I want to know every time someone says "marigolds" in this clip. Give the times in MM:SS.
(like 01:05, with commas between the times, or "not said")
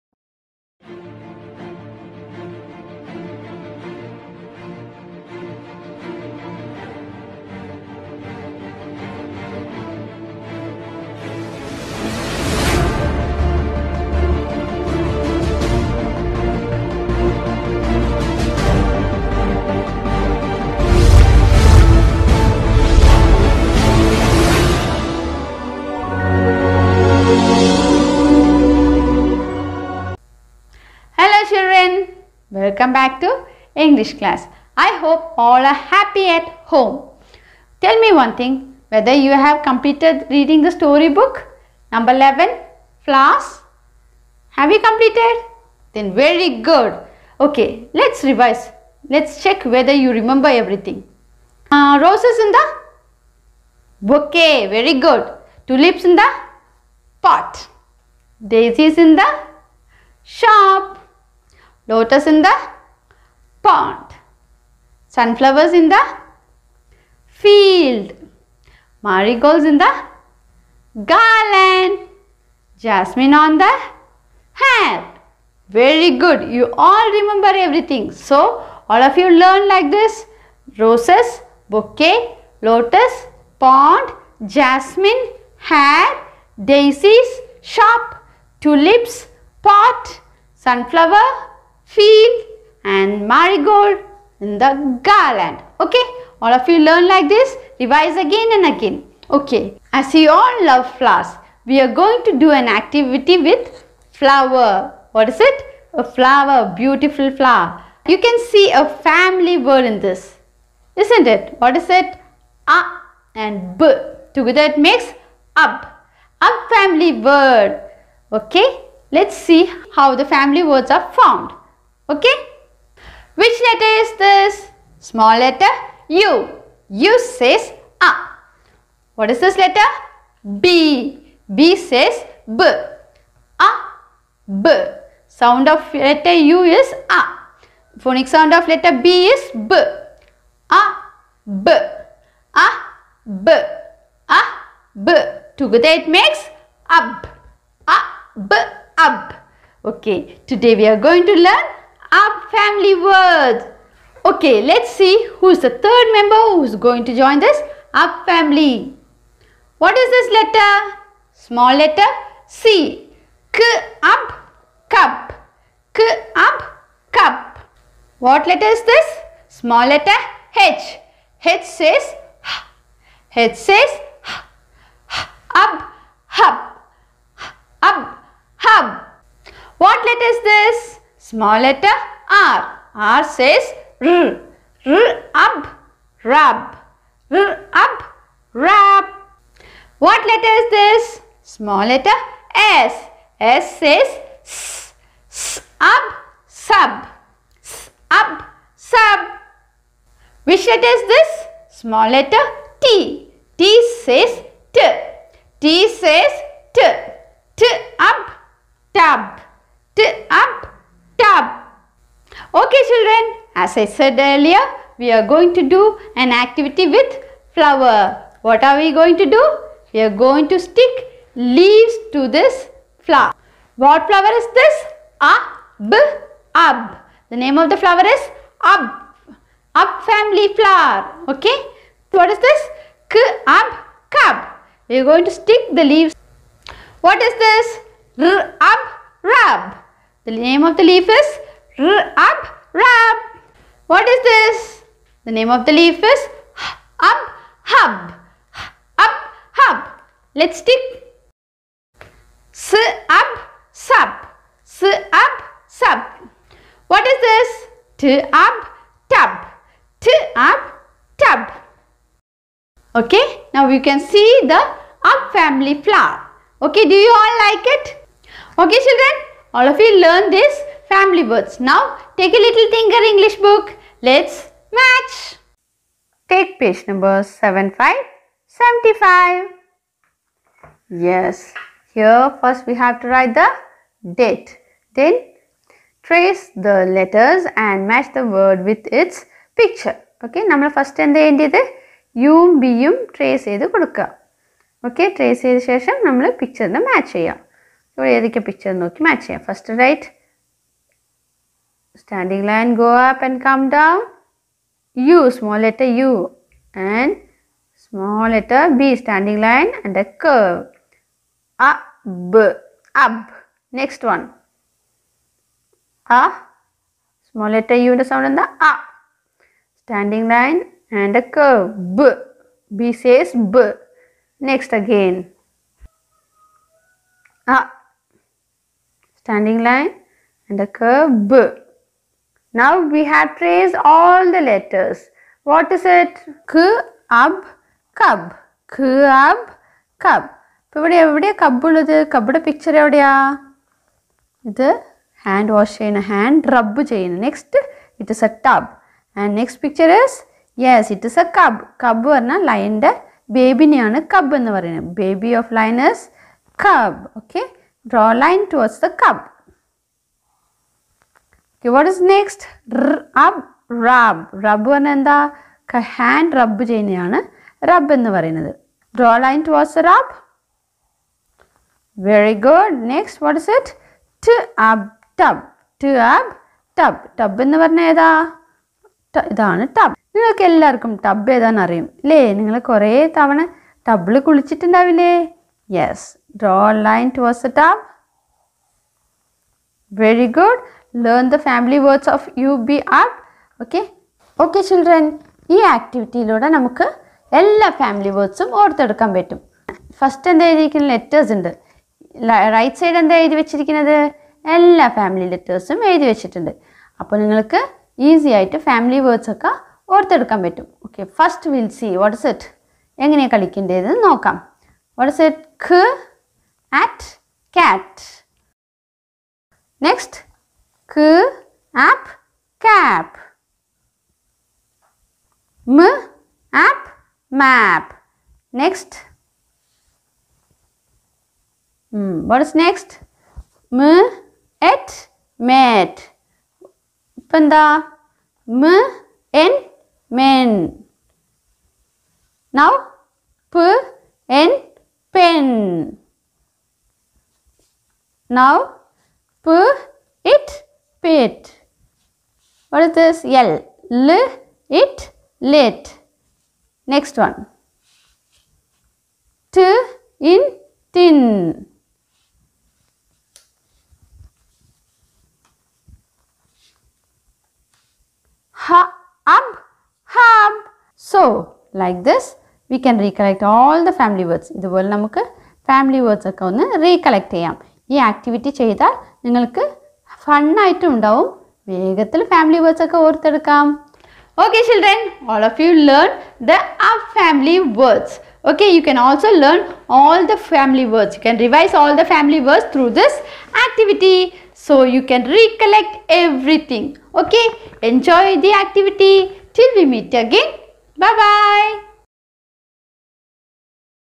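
01:09, 01:33.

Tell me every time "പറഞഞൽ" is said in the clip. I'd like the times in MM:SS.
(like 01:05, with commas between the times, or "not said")
06:04, 06:17.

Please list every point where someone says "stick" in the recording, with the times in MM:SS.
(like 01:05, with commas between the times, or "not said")
03:40, 03:55, 04:10.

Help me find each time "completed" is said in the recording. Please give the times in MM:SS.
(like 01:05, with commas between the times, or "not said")
00:39, 00:44.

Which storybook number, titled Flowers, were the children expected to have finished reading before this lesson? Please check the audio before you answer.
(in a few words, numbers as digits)
11.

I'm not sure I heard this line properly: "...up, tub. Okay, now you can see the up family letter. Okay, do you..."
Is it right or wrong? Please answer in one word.
wrong.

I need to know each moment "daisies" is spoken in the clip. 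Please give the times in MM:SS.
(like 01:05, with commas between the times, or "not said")
00:58, 01:26.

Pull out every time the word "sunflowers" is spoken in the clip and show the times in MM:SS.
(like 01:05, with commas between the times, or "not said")
01:05, 01:30.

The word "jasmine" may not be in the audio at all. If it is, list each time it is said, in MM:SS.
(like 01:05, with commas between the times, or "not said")
01:12, 01:24.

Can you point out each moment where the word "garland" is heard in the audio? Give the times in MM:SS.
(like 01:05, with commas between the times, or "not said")
01:11, 01:35.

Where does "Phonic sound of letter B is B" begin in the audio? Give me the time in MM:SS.
02:17.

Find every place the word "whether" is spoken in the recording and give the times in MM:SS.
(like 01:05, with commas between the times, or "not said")
00:38, 00:49.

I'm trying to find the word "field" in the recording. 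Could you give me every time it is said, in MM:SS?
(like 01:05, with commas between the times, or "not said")
01:07, 01:31.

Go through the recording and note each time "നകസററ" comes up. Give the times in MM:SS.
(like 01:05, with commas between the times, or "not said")
06:02, 06:12, 06:59.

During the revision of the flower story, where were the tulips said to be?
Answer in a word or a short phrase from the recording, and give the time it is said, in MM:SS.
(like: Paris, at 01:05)
In the pot, at 00:55.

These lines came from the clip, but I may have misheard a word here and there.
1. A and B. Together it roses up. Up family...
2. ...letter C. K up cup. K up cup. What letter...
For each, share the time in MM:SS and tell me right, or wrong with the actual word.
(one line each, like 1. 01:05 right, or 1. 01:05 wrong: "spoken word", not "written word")
1. 01:52 wrong: "makes", not "roses"
2. 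02:41 right.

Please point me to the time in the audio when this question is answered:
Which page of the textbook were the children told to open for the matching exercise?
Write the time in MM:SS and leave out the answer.
04:36.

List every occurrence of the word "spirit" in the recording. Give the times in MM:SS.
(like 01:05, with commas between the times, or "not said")
not said.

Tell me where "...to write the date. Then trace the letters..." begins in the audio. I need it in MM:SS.
04:43.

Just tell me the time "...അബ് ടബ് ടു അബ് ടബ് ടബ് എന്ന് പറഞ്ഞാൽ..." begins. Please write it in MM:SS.
06:14.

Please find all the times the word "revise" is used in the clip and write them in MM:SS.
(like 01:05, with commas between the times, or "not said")
00:48, 01:37, 08:11.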